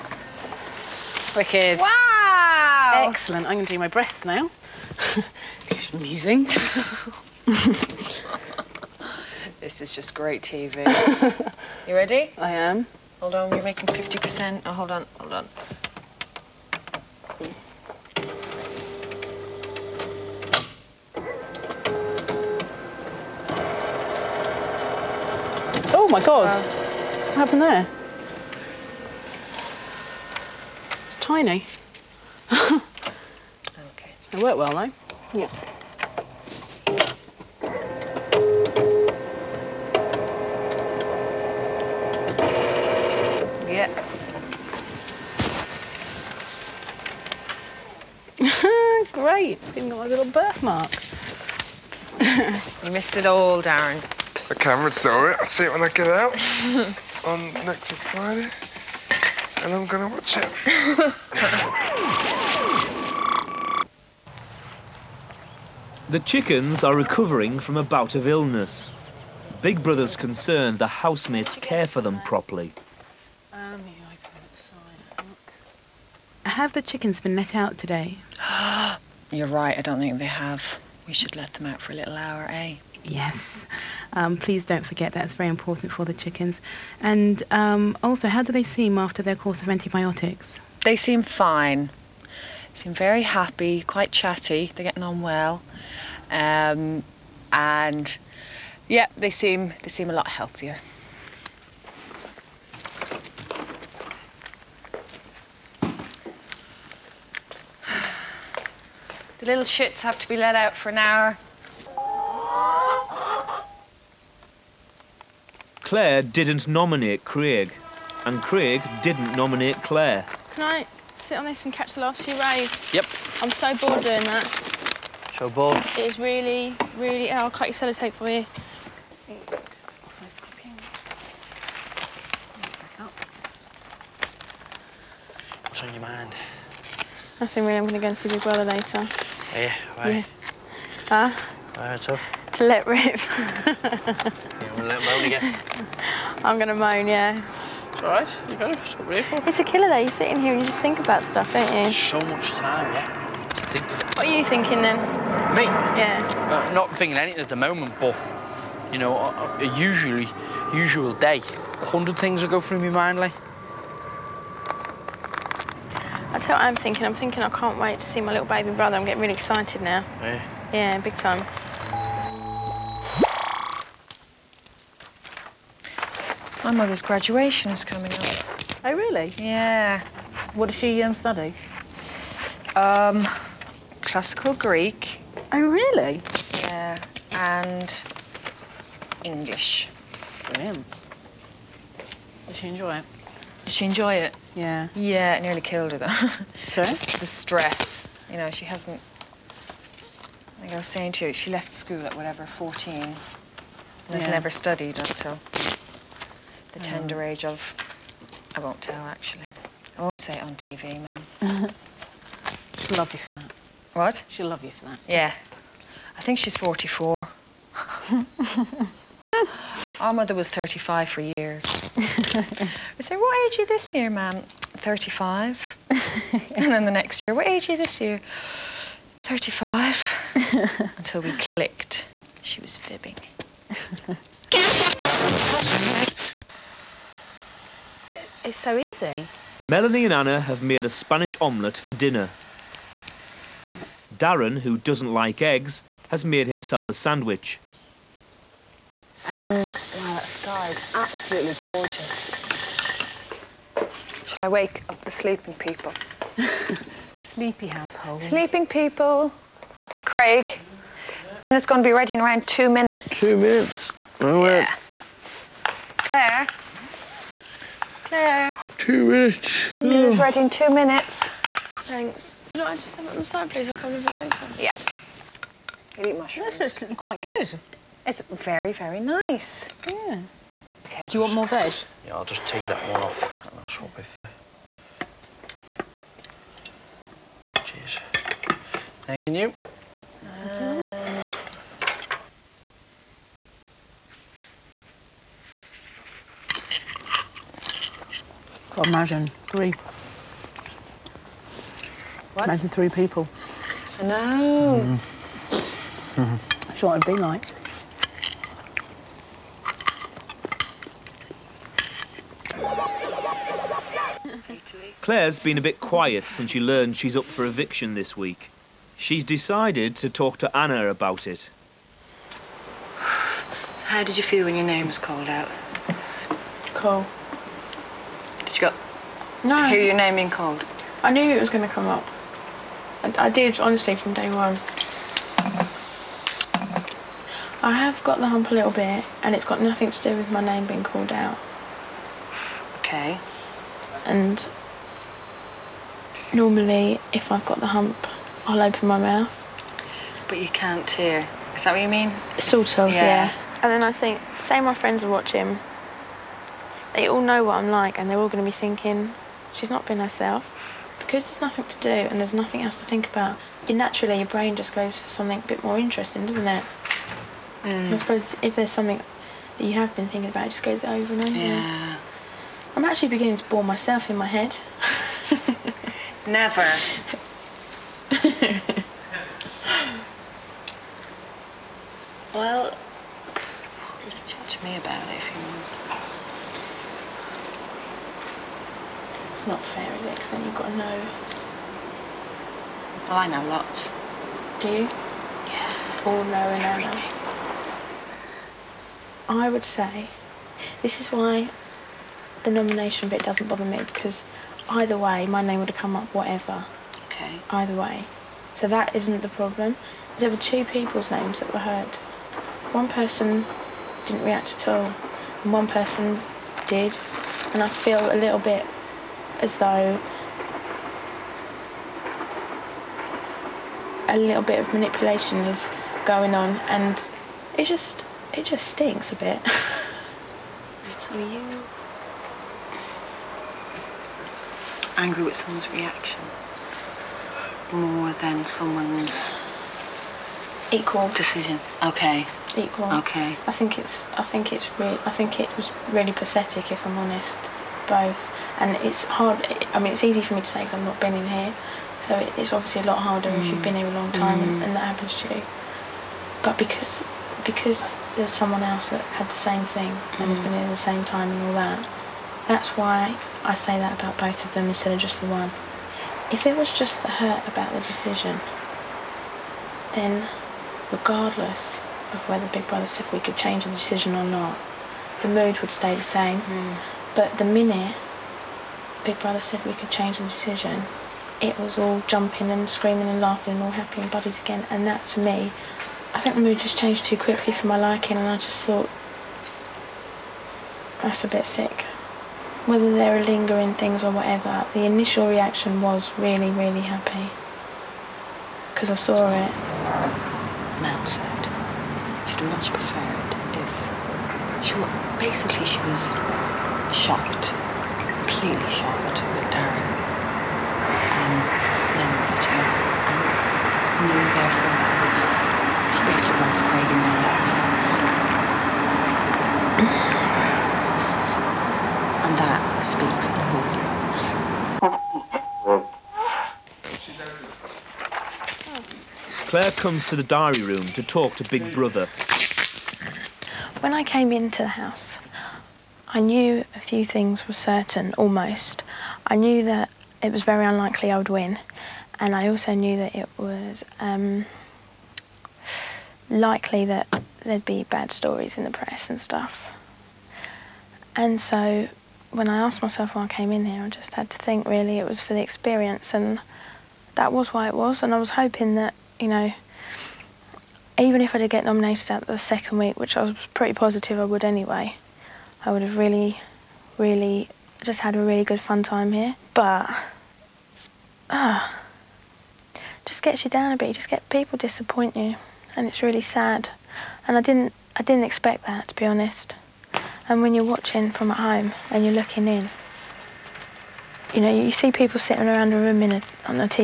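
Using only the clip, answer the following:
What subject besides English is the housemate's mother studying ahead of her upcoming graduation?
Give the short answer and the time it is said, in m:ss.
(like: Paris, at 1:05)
Classical Greek, at 3:04.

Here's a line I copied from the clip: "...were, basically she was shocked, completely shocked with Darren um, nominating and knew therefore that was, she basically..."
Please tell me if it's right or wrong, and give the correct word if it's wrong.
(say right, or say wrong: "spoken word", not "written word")
right.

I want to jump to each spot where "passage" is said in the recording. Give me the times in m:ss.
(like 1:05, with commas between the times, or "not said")
not said.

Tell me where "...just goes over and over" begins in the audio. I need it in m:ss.
6:10.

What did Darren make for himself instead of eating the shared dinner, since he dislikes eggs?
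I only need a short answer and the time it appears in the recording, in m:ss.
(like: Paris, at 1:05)
A sandwich, at 4:06.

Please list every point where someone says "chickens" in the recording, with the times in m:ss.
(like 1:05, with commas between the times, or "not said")
1:06, 1:16, 1:26.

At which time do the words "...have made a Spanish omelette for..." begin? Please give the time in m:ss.
4:00.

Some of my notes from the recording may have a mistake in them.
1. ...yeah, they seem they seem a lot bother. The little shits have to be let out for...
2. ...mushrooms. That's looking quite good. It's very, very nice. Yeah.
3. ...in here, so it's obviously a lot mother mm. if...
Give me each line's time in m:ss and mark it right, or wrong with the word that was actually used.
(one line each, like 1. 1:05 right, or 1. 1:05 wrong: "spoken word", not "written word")
1. 1:38 wrong: "healthier", not "bother"
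2. 4:36 right
3. 7:31 wrong: "harder", not "mother".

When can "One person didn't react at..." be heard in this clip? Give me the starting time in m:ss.
6:52.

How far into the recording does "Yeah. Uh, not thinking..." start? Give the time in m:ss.
2:35.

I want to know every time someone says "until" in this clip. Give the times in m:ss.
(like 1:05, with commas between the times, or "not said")
3:24, 3:50.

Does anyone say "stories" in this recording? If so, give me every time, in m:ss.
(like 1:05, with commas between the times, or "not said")
9:08.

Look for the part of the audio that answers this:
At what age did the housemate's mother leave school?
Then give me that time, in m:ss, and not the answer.
3:22.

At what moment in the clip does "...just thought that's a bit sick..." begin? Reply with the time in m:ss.
8:08.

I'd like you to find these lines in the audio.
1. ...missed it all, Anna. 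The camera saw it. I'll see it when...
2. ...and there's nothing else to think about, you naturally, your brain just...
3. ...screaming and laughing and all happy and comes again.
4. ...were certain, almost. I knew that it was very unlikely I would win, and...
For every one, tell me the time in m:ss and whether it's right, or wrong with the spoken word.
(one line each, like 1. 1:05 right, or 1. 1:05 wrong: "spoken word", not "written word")
1. 0:52 wrong: "Darren", not "Anna"
2. 6:01 right
3. 8:02 wrong: "buddies", not "comes"
4. 8:57 right.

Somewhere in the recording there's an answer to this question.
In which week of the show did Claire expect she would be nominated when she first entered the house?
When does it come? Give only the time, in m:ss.
9:22.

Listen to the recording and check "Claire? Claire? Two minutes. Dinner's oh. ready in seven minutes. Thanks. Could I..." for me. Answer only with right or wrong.
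wrong.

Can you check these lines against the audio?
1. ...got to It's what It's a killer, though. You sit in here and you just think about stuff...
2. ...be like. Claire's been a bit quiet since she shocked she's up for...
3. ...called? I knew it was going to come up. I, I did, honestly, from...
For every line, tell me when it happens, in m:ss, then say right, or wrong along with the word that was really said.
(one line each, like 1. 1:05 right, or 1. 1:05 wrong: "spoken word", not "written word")
1. 2:28 right
2. 5:07 wrong: "learned", not "shocked"
3. 5:30 right.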